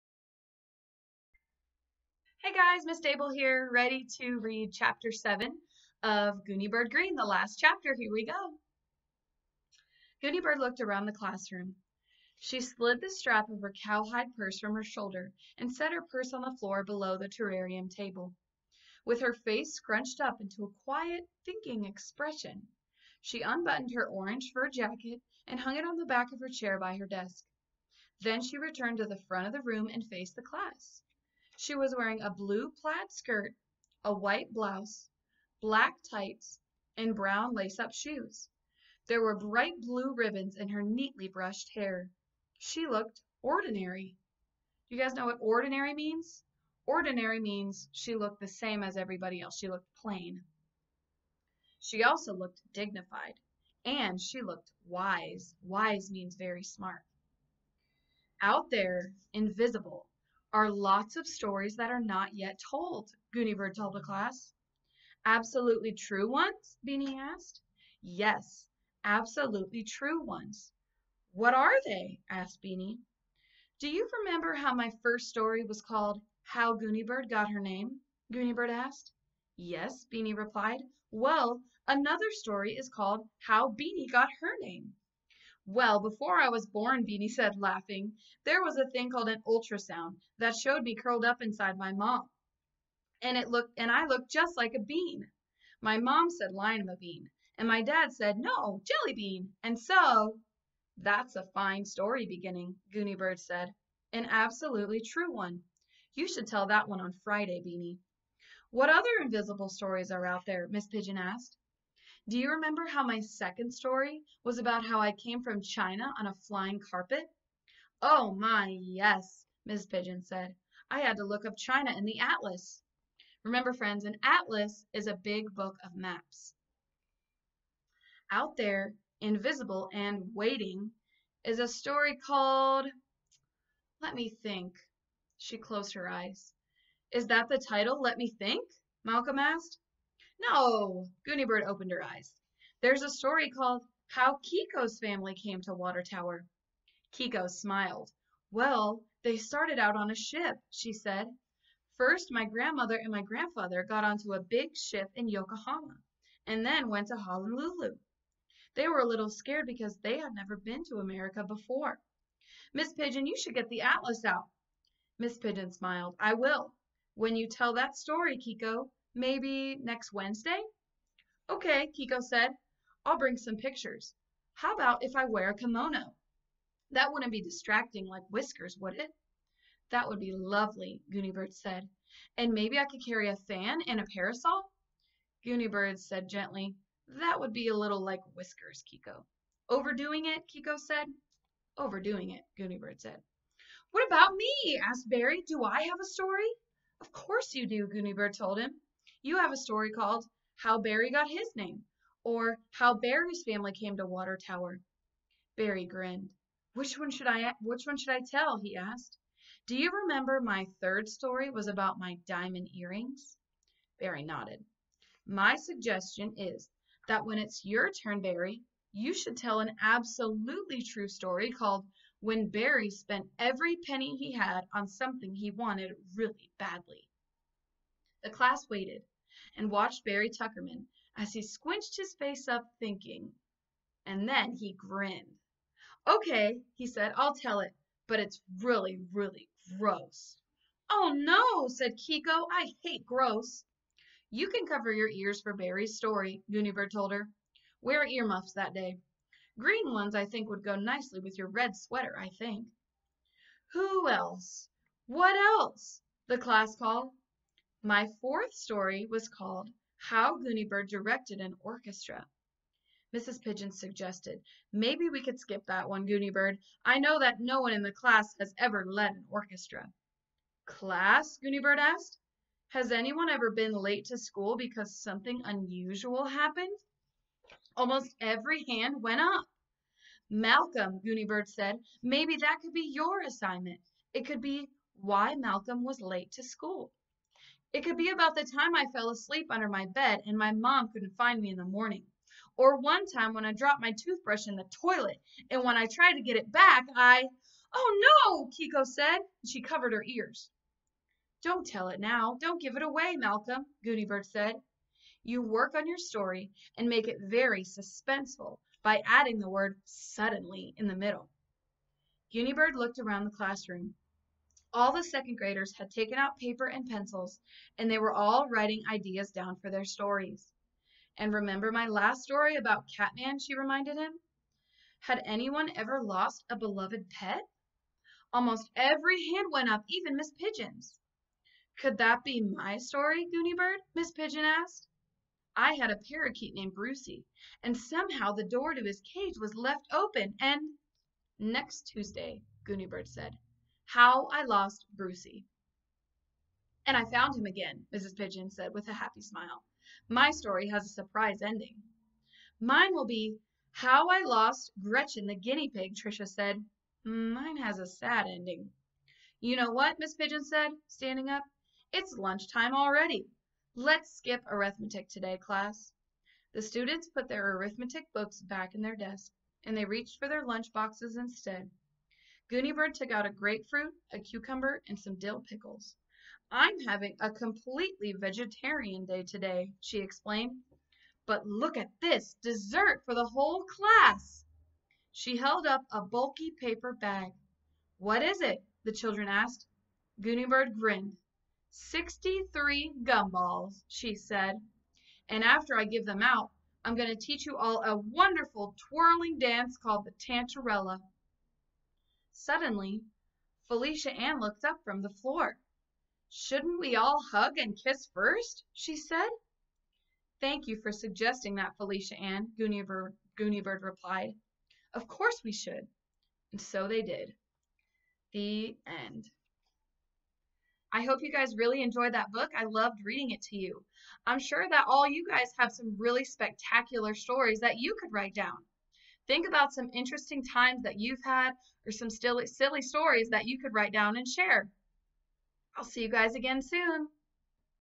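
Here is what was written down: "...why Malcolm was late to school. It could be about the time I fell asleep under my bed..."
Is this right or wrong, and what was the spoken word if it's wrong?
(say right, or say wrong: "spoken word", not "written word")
right.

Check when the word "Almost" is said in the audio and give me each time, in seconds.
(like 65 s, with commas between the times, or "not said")
277 s, 328 s.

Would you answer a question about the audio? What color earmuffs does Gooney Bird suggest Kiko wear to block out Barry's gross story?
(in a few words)
Green.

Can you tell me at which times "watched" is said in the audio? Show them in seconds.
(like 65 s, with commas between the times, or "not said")
229 s.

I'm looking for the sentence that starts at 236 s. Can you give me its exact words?
Okay, he said, I'll tell it, but it's really, really gross.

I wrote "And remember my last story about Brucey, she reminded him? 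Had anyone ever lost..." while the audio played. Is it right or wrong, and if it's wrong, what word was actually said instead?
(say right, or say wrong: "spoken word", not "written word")
wrong: "Catman", not "Brucey".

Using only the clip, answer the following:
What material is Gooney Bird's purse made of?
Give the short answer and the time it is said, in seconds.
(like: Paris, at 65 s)
Cowhide, at 13 s.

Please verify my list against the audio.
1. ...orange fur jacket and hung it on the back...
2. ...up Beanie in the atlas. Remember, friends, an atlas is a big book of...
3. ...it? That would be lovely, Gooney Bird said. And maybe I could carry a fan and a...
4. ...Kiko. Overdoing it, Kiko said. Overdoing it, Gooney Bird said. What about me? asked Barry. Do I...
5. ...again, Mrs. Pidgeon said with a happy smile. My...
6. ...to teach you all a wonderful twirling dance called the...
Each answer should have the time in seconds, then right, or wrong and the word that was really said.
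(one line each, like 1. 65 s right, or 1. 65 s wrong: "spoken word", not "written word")
1. 24 s right
2. 121 s wrong: "China", not "Beanie"
3. 178 s right
4. 188 s right
5. 347 s right
6. 397 s right.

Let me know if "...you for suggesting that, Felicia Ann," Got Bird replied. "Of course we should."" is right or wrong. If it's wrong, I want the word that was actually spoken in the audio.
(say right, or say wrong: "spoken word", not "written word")
wrong: "Gooney", not "Got".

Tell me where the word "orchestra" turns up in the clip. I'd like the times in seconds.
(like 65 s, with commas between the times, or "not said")
261 s, 269 s.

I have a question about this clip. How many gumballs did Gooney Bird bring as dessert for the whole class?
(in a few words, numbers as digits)
63.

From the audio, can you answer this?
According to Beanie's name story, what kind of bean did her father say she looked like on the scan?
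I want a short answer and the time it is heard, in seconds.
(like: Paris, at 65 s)
Jelly bean, at 98 s.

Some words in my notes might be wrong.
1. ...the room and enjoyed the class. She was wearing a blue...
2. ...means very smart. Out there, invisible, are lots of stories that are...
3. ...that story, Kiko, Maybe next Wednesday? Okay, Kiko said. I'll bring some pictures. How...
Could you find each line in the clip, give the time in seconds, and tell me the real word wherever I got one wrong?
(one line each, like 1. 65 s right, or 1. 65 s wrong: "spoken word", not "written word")
1. 29 s wrong: "faced", not "enjoyed"
2. 56 s right
3. 167 s right.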